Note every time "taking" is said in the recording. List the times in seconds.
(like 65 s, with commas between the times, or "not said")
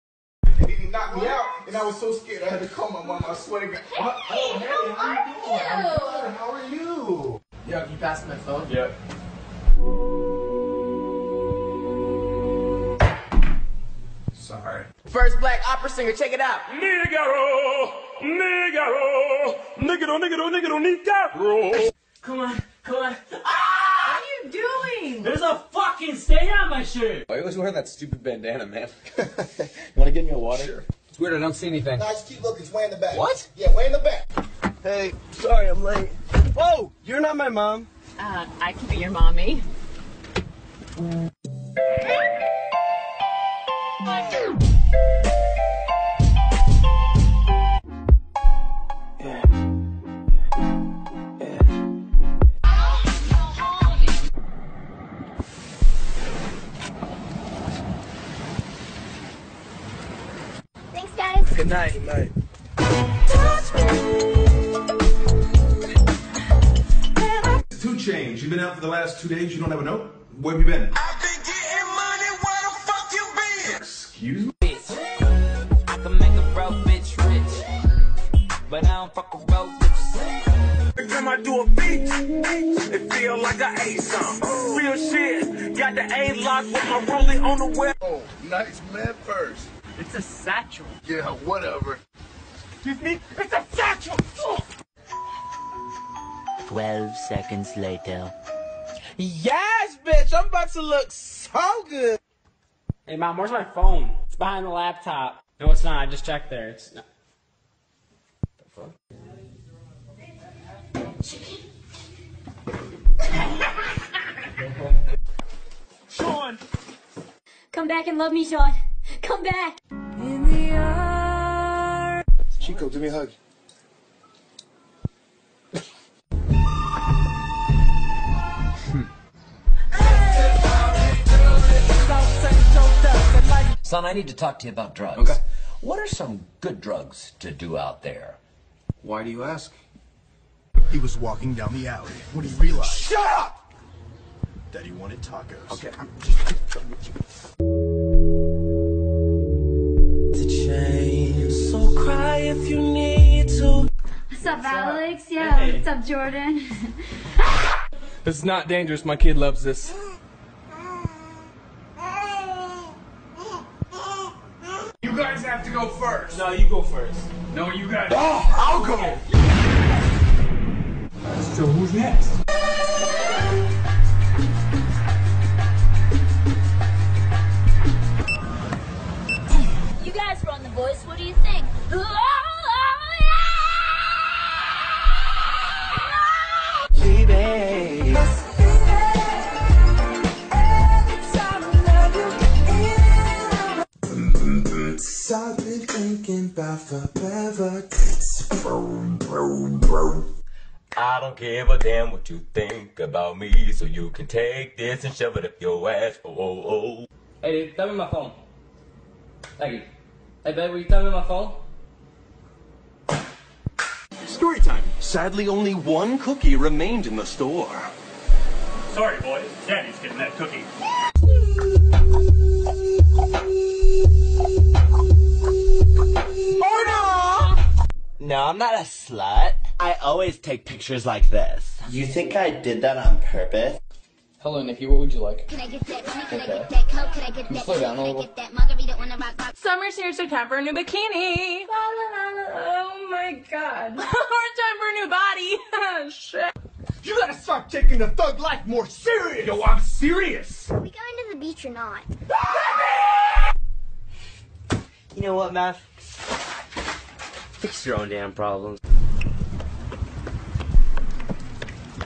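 247 s.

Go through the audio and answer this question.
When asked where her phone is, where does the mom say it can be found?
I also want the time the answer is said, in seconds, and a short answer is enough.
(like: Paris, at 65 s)
Behind the laptop, at 104 s.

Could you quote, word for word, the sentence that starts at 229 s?
I always take pictures like this.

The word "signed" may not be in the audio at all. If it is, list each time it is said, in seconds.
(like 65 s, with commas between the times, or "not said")
not said.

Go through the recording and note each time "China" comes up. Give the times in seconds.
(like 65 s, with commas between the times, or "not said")
not said.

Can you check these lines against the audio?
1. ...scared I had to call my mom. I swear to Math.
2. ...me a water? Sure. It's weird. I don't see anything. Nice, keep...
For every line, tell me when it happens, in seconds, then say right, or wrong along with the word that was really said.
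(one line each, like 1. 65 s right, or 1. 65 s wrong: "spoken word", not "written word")
1. 2 s wrong: "God", not "Math"
2. 30 s right.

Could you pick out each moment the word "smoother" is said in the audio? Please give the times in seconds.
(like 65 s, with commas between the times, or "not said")
not said.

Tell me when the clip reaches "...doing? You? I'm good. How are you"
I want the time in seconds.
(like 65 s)
6 s.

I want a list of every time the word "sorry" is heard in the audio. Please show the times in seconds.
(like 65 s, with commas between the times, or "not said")
14 s, 35 s, 218 s.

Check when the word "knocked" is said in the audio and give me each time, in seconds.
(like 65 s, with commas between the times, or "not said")
0 s.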